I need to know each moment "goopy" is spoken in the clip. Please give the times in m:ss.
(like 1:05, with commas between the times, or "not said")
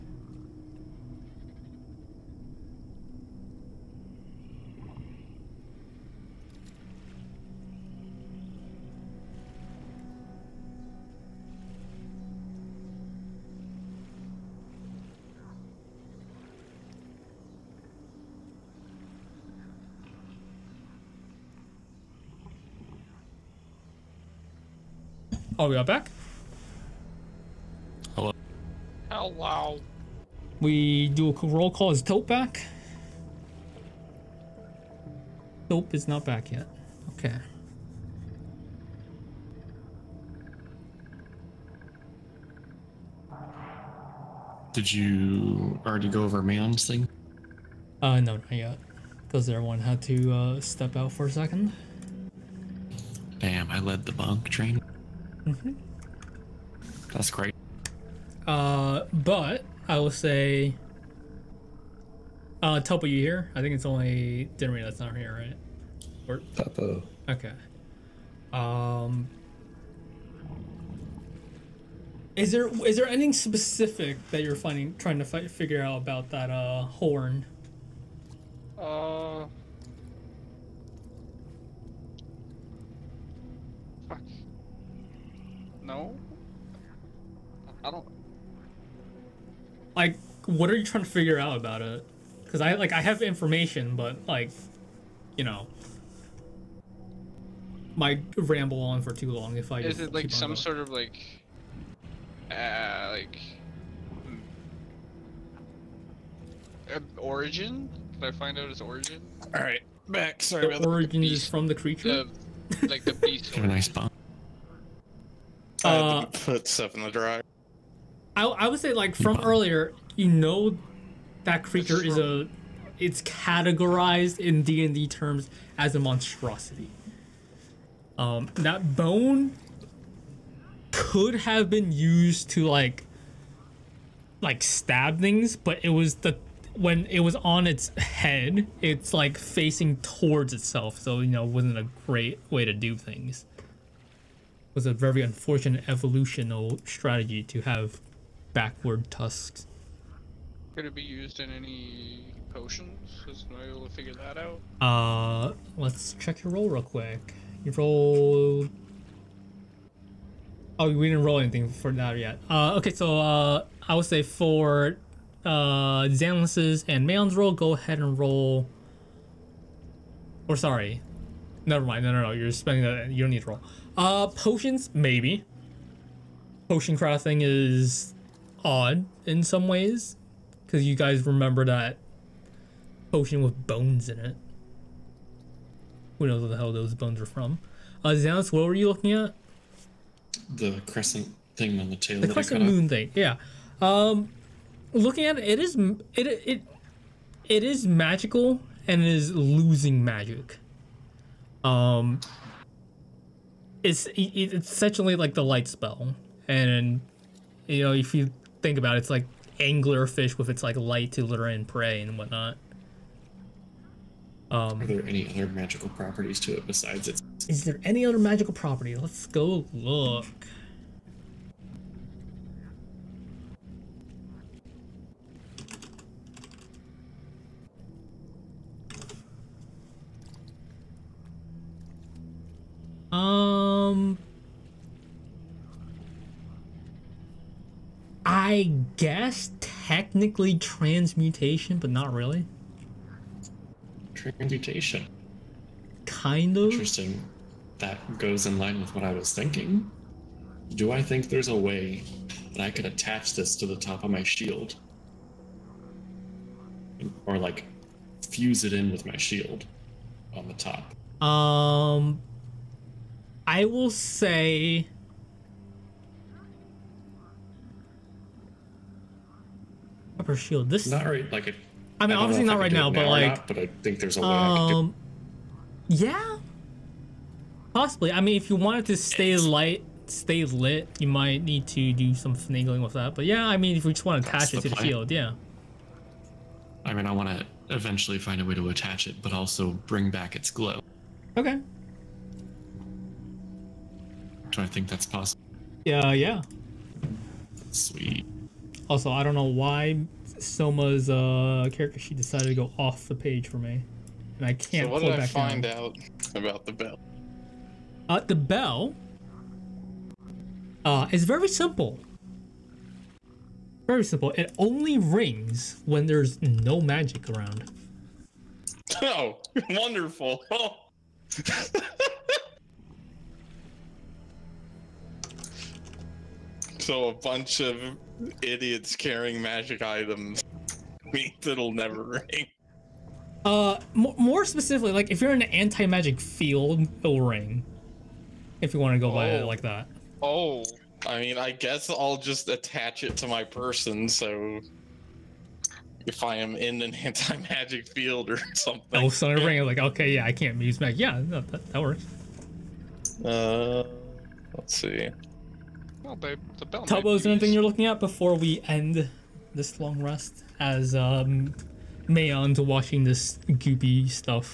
6:03.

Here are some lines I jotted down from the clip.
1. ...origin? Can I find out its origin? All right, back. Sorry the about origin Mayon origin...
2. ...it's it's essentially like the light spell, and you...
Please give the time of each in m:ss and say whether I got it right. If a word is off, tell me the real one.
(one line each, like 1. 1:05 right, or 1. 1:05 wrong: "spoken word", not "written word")
1. 1:47 wrong: "The", not "Mayon"
2. 3:23 right.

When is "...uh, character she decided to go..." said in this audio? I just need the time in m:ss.
5:01.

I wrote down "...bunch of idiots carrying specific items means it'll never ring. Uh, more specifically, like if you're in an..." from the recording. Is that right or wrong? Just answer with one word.
wrong.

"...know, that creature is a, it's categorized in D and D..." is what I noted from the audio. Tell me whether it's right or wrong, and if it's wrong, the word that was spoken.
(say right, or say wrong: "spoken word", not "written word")
right.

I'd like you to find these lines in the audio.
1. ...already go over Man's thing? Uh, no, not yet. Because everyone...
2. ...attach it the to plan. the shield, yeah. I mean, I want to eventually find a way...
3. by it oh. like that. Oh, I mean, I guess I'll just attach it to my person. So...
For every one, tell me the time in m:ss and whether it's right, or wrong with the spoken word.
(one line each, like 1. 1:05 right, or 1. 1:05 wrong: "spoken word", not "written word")
1. 0:45 right
2. 4:44 right
3. 5:39 right.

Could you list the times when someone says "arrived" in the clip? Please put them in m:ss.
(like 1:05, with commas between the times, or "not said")
not said.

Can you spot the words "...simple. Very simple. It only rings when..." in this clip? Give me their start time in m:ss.
5:11.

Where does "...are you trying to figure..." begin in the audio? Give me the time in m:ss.
1:30.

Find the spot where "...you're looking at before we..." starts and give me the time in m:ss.
5:57.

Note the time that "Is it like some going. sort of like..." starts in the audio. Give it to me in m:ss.
1:39.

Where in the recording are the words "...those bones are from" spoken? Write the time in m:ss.
3:06.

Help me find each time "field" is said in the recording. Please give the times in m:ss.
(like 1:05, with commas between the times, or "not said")
5:36, 5:47.